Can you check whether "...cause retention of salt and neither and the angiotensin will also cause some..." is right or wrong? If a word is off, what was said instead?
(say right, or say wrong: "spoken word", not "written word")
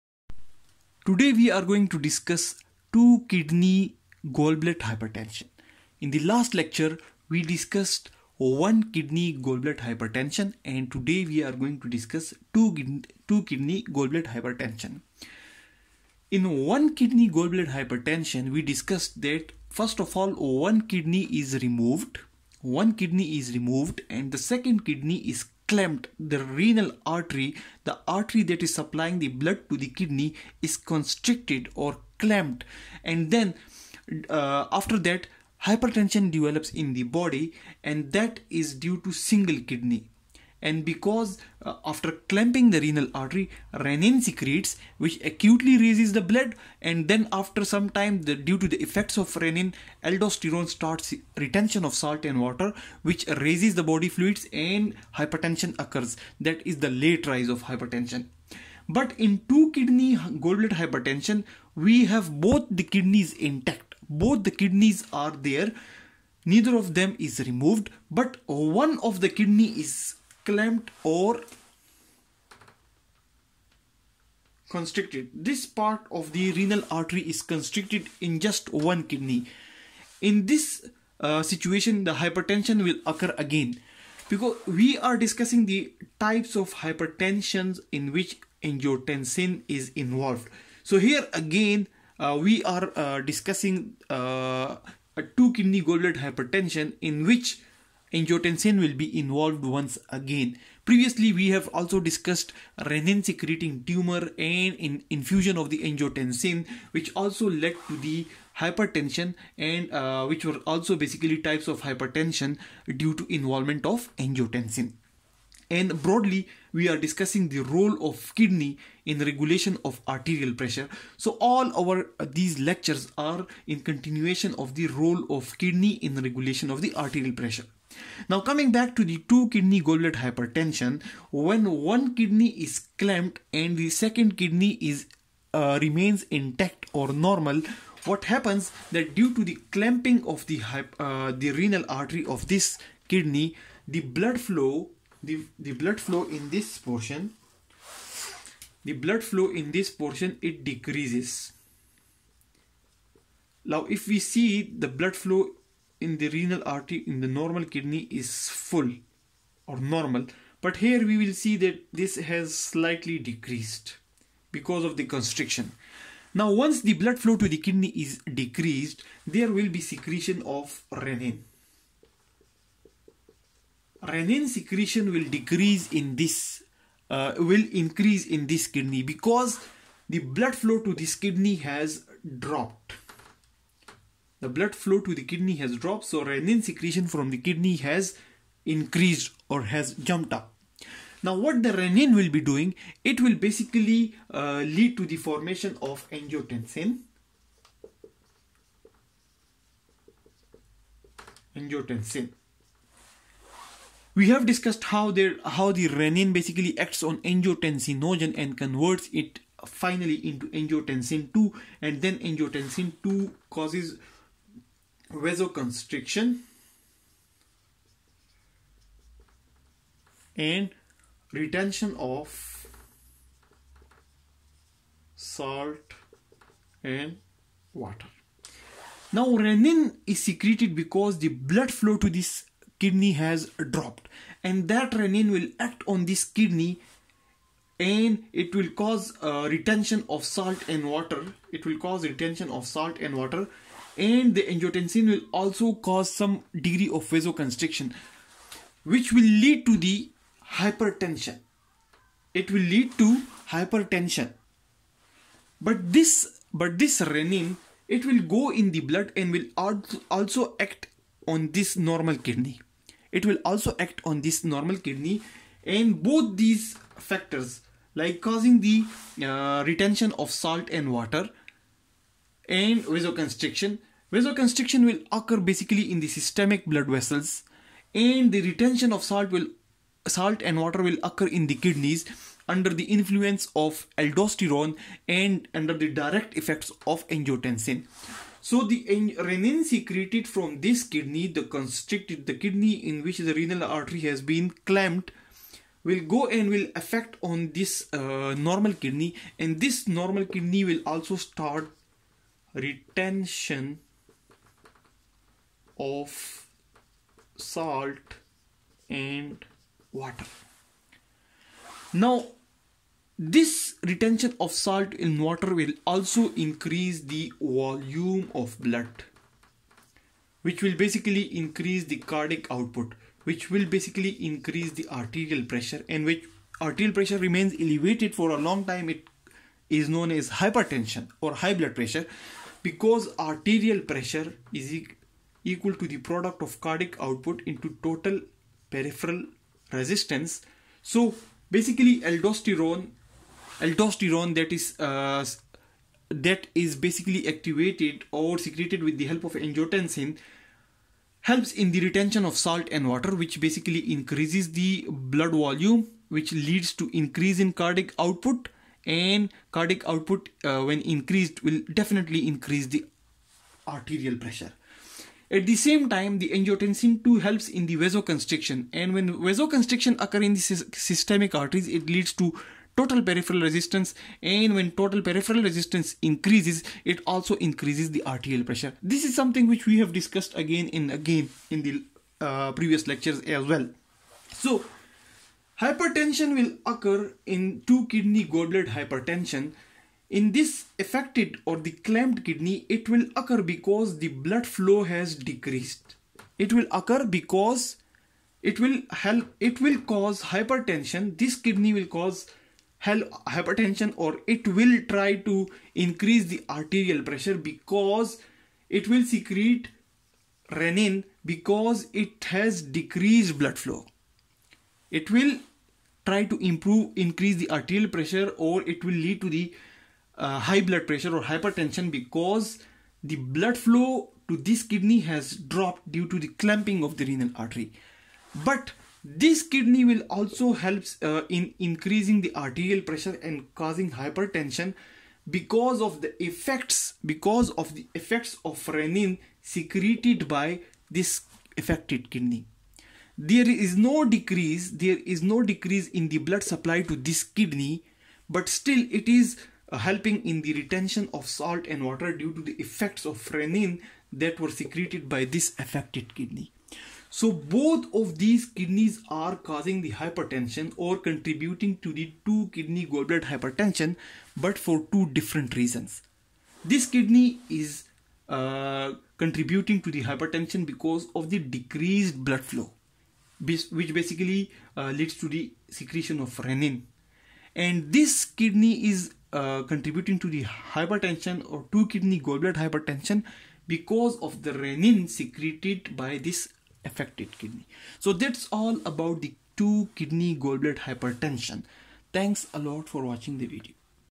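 wrong: "water", not "neither".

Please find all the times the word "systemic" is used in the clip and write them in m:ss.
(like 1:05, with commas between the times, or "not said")
4:36, 6:10.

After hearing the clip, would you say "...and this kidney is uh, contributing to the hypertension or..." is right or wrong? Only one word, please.
right.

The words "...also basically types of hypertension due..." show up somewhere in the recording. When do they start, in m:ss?
1:50.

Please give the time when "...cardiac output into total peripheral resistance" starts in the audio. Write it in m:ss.
5:36.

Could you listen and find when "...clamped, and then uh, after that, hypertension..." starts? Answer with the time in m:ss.
0:32.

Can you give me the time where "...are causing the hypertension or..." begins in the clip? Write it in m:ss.
7:39.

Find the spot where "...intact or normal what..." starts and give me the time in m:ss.
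2:16.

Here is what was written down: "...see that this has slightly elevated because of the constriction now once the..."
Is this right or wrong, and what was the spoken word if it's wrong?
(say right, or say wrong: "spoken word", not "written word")
wrong: "decreased", not "elevated".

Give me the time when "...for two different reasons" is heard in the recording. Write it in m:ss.
7:44.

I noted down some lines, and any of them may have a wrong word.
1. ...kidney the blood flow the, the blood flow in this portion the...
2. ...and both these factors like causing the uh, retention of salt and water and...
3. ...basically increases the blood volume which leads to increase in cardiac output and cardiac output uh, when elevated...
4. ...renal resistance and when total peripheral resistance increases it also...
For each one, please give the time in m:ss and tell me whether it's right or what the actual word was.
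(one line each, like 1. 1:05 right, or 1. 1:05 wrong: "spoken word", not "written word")
1. 2:23 right
2. 4:25 right
3. 5:53 wrong: "increased", not "elevated"
4. 6:13 wrong: "peripheral", not "renal".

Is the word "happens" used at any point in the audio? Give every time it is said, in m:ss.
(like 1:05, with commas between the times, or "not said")
2:18.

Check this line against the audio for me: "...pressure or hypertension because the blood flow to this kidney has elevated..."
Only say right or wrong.
wrong.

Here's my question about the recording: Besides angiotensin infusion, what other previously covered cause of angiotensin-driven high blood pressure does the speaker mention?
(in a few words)
renin secreting tumor.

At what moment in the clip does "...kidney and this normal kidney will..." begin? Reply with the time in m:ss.
4:58.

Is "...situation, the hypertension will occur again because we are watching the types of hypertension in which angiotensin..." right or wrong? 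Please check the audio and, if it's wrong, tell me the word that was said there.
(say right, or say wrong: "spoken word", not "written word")
wrong: "discussing", not "watching".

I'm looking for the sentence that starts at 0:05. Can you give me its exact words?
In the last lecture we discussed one kidney Goldblatt hypertension and today we are going to discuss two, two kidney Goldblatt hypertension.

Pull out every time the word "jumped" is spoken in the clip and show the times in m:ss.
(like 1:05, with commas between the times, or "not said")
3:09.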